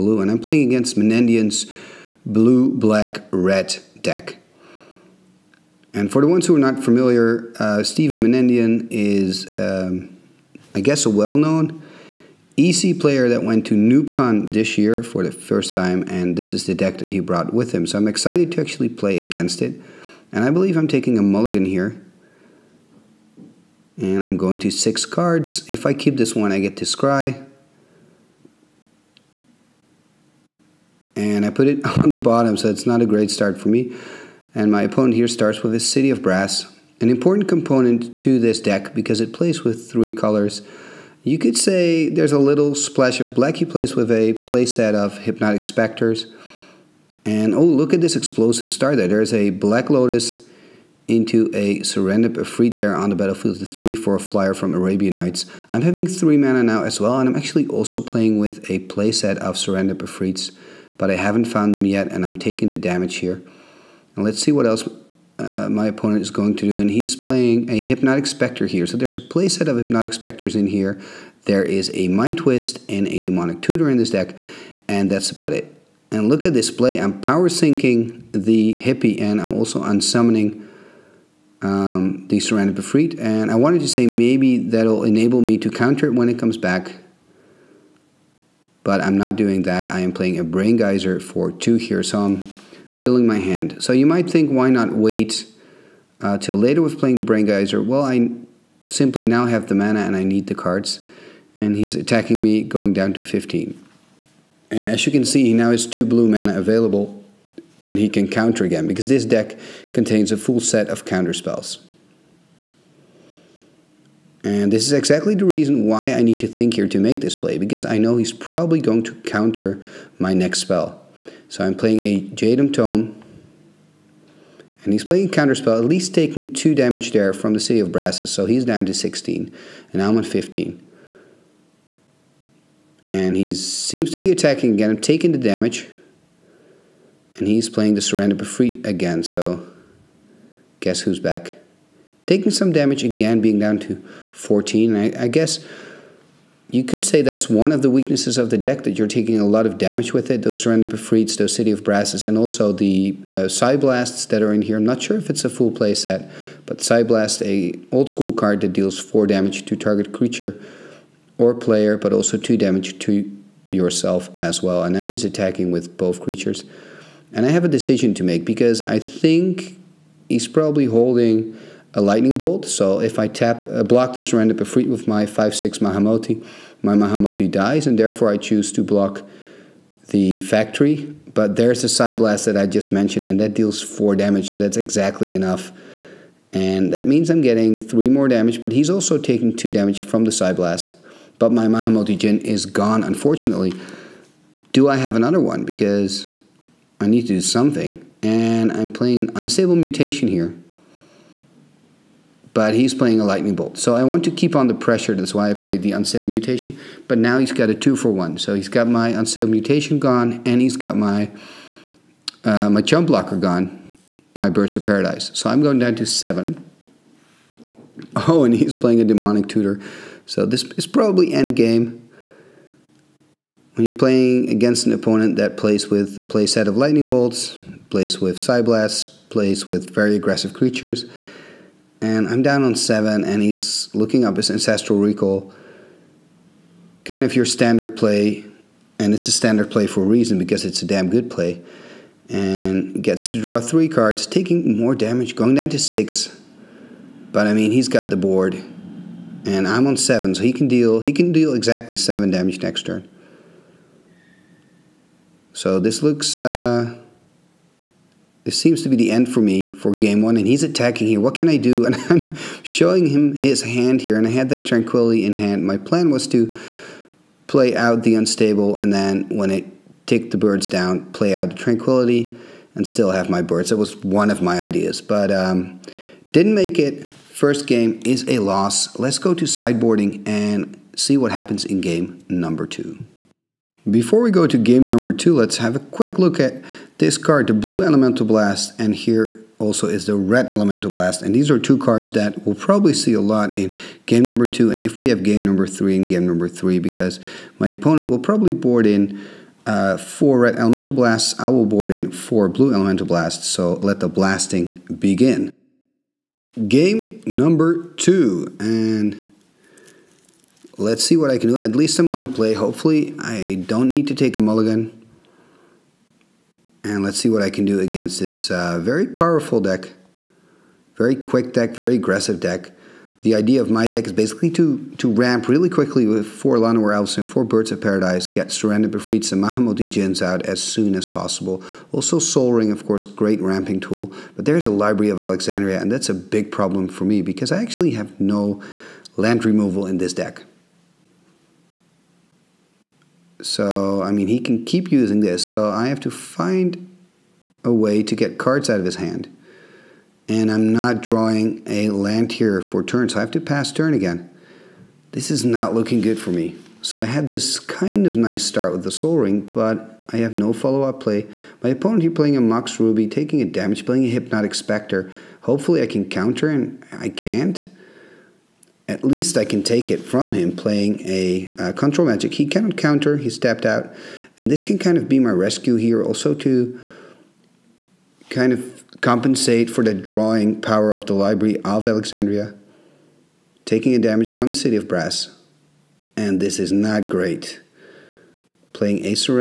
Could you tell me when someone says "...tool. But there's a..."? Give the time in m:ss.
5:33.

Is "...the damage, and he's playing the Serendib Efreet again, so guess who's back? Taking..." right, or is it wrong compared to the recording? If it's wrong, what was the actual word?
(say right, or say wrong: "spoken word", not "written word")
right.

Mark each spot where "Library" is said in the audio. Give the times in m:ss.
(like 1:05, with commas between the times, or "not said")
5:34, 6:21.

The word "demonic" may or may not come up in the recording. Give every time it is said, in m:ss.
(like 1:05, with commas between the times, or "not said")
1:13, 3:39.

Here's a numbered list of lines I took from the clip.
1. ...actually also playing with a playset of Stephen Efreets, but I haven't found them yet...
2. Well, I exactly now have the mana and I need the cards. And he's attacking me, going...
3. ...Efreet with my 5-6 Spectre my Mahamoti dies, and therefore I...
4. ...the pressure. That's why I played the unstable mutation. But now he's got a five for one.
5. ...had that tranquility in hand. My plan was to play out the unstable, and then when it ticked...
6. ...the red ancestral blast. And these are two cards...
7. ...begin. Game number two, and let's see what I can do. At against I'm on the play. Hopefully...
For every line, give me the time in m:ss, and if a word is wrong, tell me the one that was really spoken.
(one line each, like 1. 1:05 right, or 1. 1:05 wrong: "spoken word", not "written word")
1. 0:57 wrong: "Serendib", not "Stephen"
2. 1:37 wrong: "simply", not "exactly"
3. 2:54 wrong: "Mahamoti", not "Spectre"
4. 3:24 wrong: "two", not "five"
5. 4:24 right
6. 4:50 wrong: "elemental", not "ancestral"
7. 5:04 wrong: "least", not "against".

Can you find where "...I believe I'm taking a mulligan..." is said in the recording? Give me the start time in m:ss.
0:20.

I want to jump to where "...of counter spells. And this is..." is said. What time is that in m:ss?
1:50.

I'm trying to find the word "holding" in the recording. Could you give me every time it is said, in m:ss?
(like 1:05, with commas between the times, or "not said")
2:50.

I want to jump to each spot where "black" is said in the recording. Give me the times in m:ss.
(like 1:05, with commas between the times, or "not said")
0:02, 0:43, 0:49.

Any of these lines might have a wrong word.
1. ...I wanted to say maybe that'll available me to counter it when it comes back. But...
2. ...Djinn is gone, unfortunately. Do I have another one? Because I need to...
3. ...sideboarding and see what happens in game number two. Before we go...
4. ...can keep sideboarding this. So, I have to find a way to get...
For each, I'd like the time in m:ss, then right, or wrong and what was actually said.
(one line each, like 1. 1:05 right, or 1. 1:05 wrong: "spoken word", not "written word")
1. 1:23 wrong: "enable", not "available"
2. 3:12 right
3. 4:39 right
4. 5:44 wrong: "using", not "sideboarding".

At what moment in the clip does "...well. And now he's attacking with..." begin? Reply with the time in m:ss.
2:44.